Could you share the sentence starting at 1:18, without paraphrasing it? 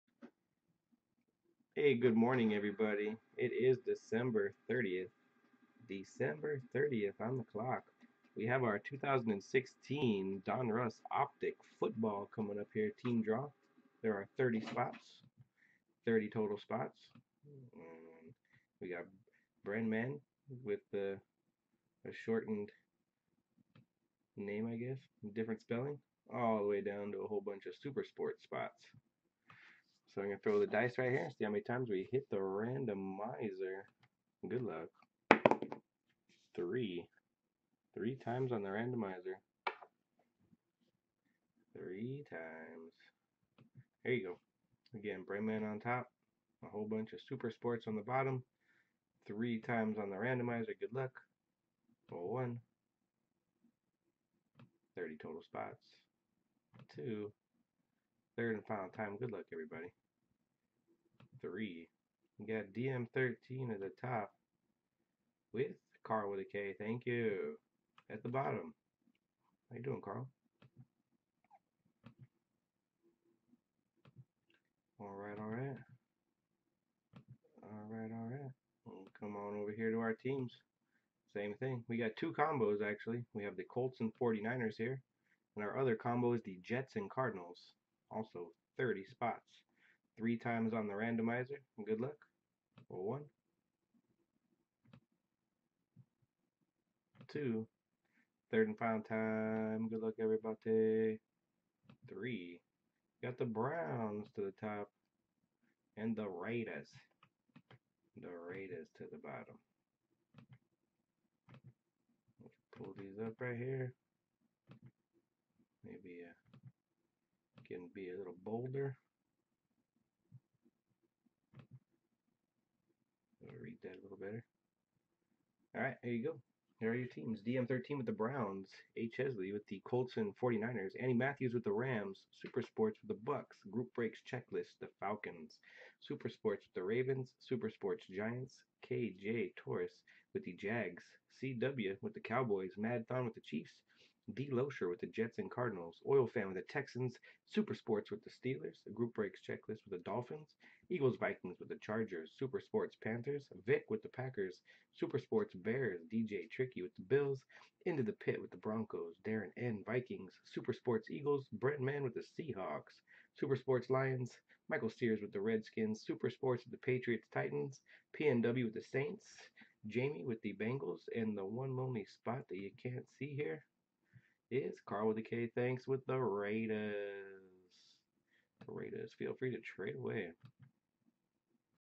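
We'll come on over here to our teams.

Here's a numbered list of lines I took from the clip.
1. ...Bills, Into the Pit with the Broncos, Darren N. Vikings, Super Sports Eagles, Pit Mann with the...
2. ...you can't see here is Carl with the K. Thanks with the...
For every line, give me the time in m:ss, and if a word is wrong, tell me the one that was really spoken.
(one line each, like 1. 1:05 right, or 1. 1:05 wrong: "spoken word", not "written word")
1. 2:37 wrong: "Brent", not "Pit"
2. 2:52 right.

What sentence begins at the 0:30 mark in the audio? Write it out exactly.
So I'm going to throw the dice right here and see how many times we hit the randomizer.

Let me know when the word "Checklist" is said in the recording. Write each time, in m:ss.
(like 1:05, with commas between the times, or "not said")
2:14, 2:29.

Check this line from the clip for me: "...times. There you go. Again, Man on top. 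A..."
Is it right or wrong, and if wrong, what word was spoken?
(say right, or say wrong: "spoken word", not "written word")
right.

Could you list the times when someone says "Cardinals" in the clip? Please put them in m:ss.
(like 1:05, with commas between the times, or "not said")
1:27, 2:25.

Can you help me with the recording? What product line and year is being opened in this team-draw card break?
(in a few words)
2016 Donruss Optic.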